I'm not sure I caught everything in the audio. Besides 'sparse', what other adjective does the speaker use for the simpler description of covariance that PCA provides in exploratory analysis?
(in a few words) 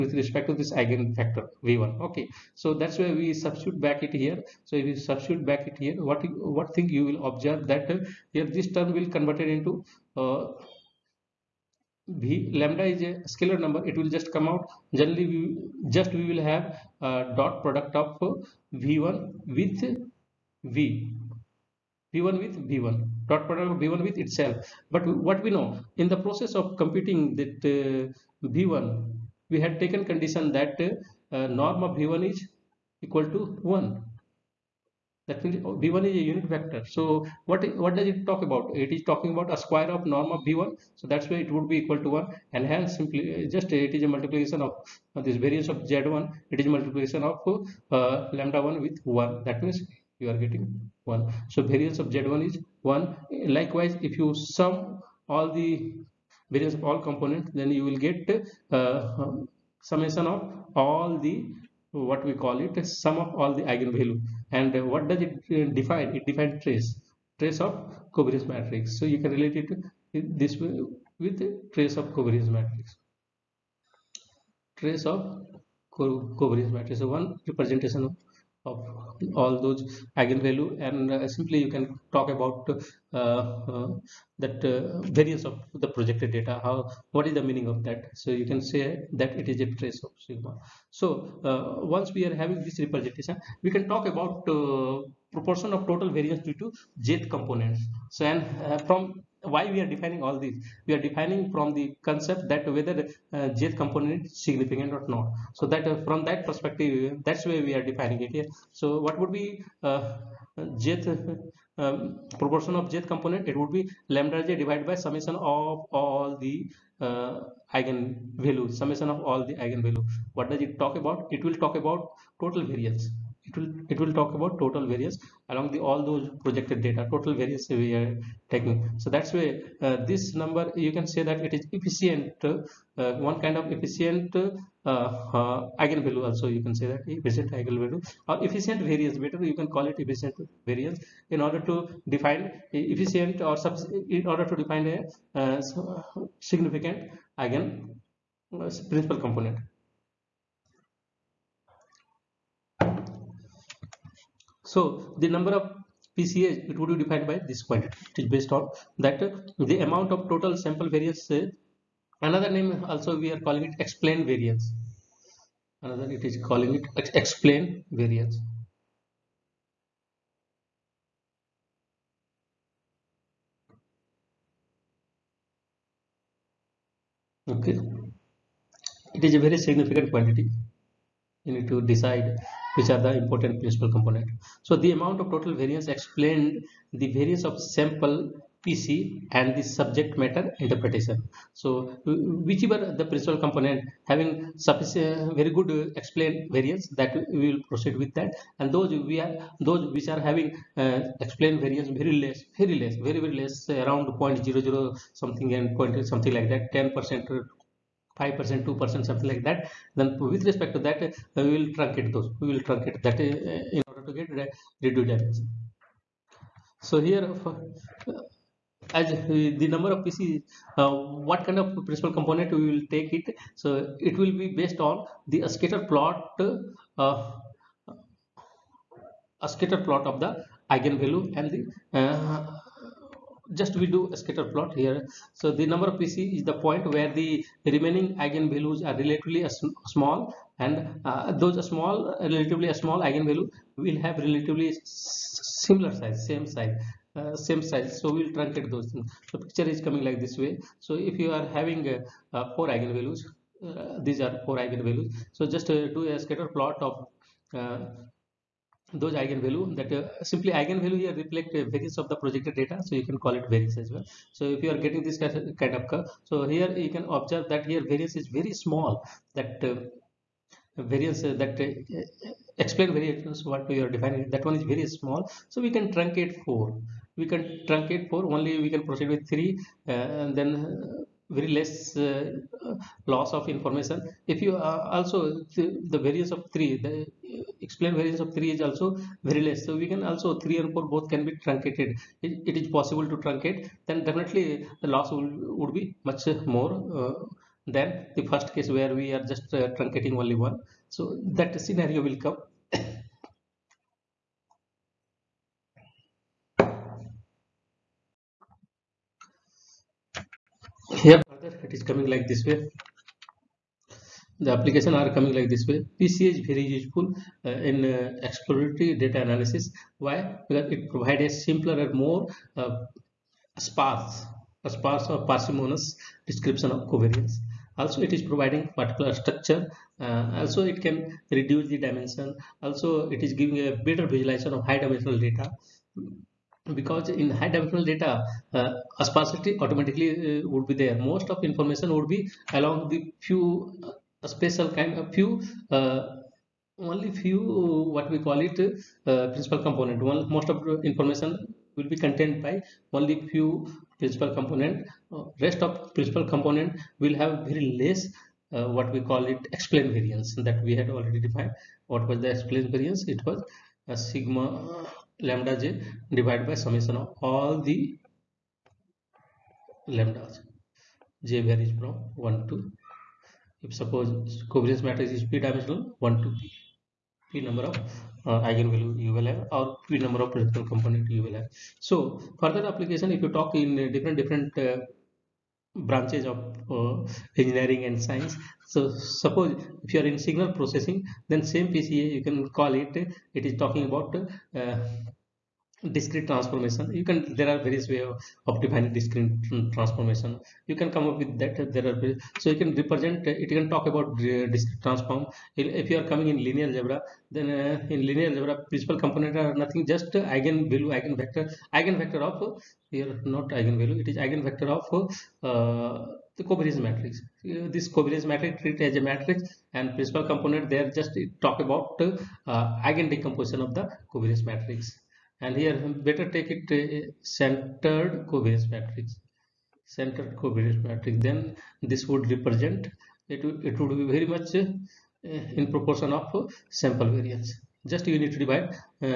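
Parsimonious.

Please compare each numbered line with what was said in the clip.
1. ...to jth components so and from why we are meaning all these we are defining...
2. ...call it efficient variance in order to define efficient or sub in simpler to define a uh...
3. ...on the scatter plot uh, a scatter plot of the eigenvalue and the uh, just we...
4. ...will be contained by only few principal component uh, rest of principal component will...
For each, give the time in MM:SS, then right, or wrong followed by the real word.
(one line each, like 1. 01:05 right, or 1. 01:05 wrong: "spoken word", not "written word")
1. 01:36 wrong: "defining", not "meaning"
2. 02:19 wrong: "order", not "simpler"
3. 03:44 right
4. 05:51 right.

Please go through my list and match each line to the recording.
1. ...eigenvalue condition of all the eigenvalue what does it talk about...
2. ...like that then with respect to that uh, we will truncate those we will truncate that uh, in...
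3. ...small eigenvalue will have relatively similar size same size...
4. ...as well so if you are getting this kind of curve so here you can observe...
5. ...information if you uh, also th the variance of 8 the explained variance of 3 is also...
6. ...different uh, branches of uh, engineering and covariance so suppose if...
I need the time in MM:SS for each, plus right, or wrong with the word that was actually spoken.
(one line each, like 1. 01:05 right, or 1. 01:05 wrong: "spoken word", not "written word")
1. 01:57 wrong: "summation", not "condition"
2. 03:29 right
3. 04:02 right
4. 04:23 right
5. 04:43 wrong: "3", not "8"
6. 06:24 wrong: "science", not "covariance".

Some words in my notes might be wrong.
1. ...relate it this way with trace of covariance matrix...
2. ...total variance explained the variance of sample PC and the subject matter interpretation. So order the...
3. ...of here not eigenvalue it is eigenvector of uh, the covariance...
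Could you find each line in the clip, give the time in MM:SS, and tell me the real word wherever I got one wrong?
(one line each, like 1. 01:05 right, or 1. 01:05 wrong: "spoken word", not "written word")
1. 01:09 right
2. 03:05 wrong: "whichever", not "order"
3. 06:52 right.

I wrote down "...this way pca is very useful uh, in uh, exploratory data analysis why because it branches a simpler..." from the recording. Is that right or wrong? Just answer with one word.
wrong.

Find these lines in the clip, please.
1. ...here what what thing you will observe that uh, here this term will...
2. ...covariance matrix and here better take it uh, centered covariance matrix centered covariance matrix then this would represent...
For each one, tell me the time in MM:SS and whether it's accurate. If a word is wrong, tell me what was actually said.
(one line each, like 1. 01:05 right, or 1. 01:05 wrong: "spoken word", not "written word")
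1. 00:05 right
2. 07:04 right.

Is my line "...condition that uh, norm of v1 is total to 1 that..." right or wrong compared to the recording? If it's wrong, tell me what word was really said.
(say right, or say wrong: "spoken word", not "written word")
wrong: "equal", not "total".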